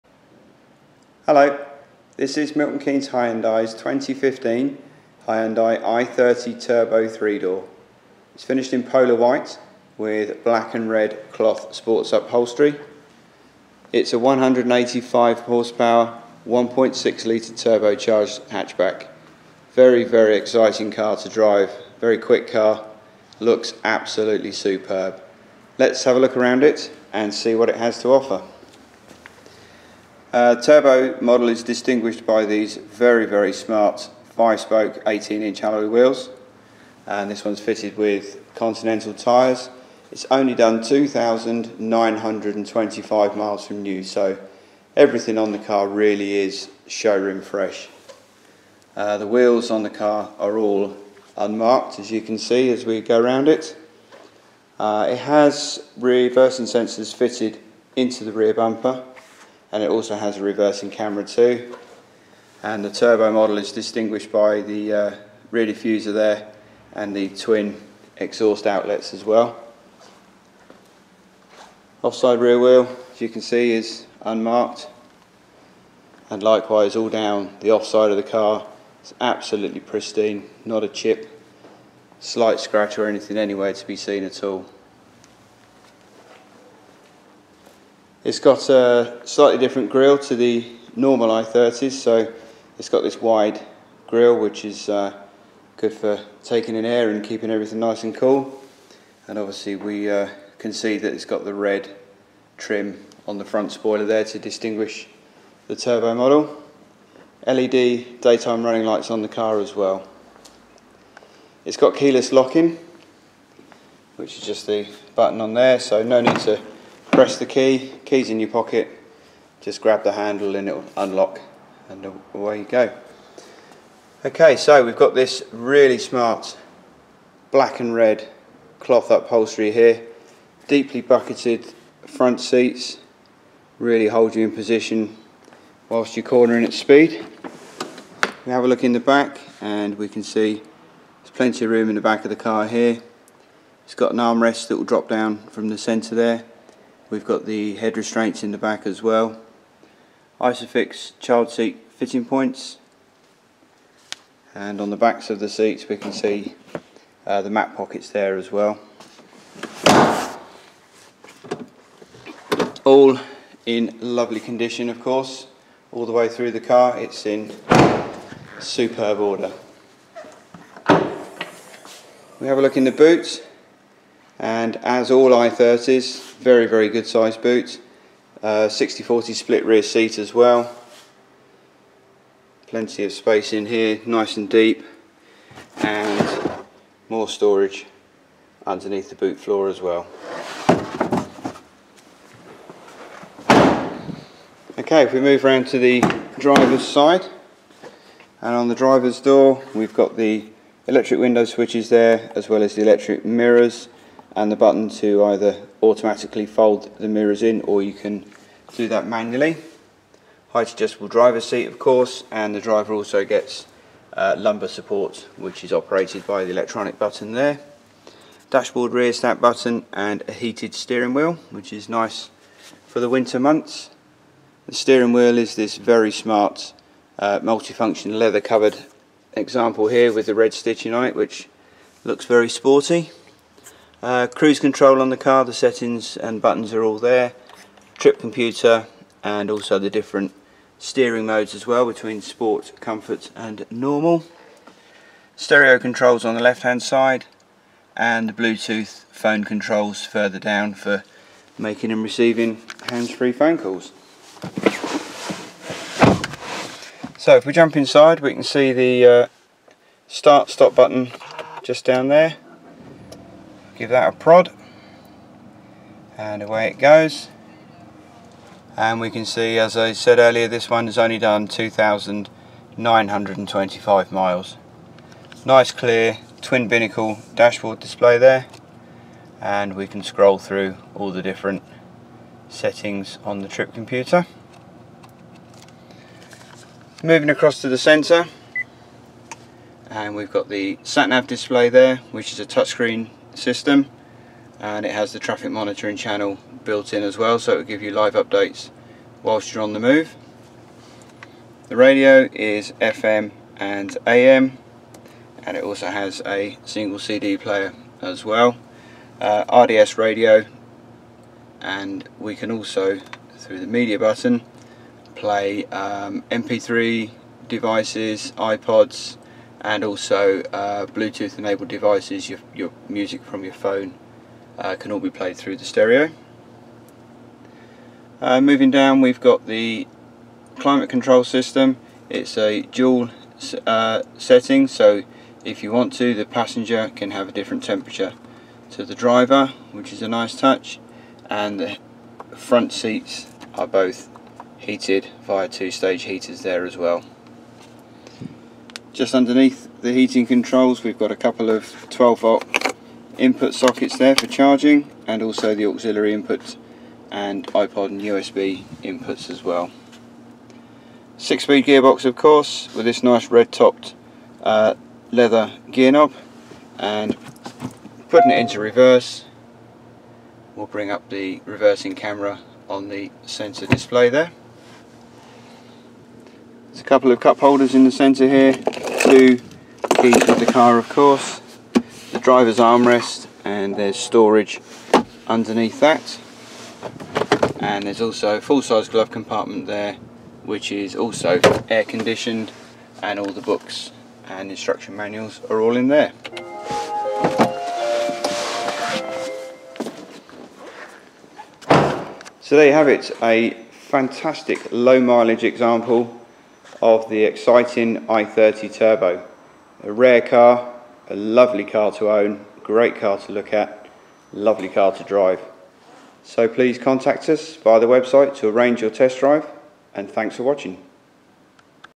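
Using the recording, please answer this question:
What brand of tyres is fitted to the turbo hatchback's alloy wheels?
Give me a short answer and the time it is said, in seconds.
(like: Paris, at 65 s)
Continental, at 38 s.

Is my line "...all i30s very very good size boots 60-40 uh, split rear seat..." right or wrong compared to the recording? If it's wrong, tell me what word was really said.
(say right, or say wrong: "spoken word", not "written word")
right.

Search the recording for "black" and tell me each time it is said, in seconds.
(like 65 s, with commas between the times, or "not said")
10 s, 127 s.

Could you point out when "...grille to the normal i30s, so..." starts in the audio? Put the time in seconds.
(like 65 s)
89 s.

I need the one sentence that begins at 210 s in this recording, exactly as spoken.
Height adjustable driver seat of course and the driver also gets uh, lumbar support which is operated by the electronic button there.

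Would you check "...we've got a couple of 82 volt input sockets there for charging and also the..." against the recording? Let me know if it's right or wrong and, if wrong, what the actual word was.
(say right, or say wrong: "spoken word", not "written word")
wrong: "12", not "82".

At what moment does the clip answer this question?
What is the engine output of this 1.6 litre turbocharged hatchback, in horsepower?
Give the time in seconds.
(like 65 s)
14 s.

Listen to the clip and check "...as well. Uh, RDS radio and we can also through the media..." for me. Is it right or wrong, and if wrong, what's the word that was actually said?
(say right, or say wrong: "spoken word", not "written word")
right.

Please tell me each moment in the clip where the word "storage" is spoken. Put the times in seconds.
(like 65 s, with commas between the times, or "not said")
187 s, 383 s.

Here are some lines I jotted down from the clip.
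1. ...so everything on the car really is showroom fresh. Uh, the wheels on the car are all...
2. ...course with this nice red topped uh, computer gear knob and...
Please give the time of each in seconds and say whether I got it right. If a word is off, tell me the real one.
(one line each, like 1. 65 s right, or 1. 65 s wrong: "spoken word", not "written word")
1. 44 s right
2. 362 s wrong: "leather", not "computer".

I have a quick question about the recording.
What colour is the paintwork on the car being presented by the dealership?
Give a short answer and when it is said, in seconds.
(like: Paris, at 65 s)
Polar white, at 8 s.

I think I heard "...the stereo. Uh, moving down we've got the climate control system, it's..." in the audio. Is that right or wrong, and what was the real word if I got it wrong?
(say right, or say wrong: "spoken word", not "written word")
right.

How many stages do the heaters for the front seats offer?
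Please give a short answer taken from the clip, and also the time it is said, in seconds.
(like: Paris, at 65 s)
2, at 345 s.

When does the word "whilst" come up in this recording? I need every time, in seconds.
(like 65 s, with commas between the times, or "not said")
135 s, 299 s.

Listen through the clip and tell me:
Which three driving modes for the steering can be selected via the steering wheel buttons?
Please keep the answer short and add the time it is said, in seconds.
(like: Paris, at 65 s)
Sport, comfort and normal, at 242 s.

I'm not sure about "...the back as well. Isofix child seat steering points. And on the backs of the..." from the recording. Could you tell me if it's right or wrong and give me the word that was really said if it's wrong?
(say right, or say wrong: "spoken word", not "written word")
wrong: "fitting", not "steering".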